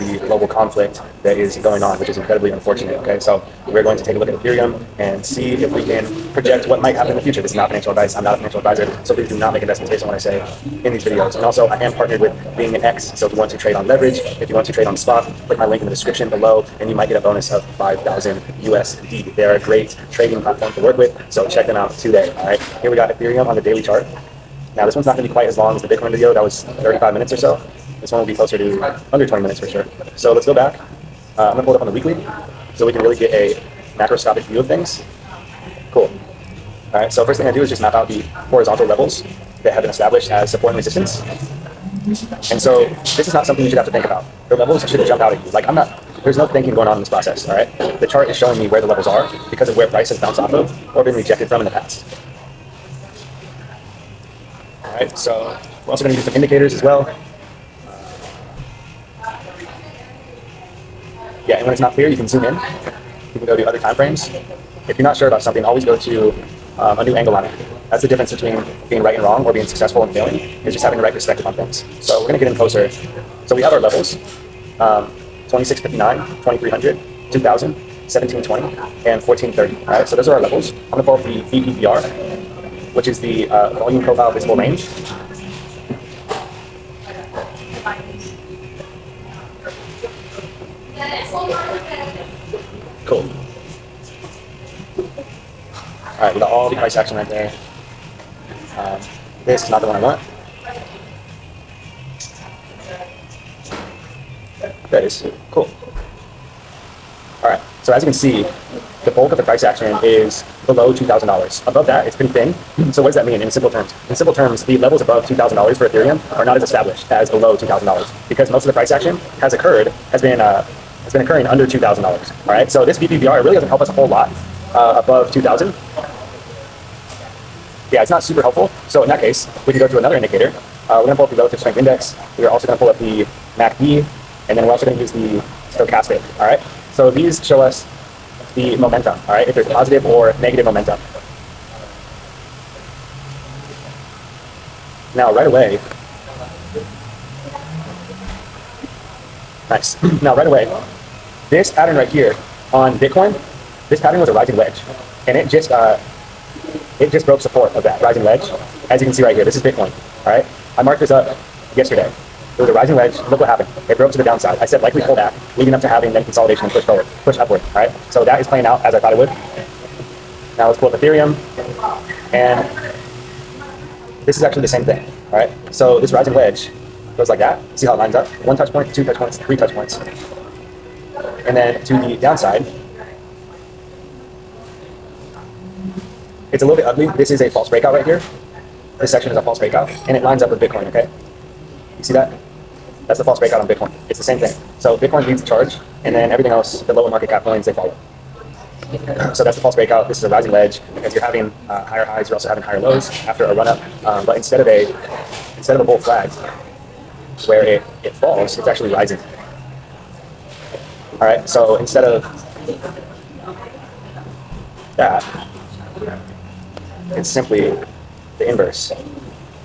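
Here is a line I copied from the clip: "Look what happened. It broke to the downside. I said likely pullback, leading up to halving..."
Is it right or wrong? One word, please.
right.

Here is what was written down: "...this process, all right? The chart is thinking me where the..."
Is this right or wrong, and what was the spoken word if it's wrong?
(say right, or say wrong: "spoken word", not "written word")
wrong: "showing", not "thinking".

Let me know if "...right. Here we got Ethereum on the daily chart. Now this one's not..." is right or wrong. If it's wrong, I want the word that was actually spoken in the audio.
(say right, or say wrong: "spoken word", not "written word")
right.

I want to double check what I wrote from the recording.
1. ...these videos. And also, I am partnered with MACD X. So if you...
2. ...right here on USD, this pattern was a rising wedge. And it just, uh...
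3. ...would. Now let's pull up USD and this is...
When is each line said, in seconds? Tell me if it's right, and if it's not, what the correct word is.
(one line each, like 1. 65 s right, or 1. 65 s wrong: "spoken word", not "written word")
1. 10 s wrong: "Being", not "MACD"
2. 151 s wrong: "Bitcoin", not "USD"
3. 169 s wrong: "Ethereum", not "USD".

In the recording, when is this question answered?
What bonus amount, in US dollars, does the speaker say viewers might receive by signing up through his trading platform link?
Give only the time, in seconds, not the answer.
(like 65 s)
17 s.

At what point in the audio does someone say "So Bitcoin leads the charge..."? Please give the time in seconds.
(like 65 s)
194 s.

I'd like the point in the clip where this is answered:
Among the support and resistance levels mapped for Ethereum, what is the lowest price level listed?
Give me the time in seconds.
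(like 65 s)
79 s.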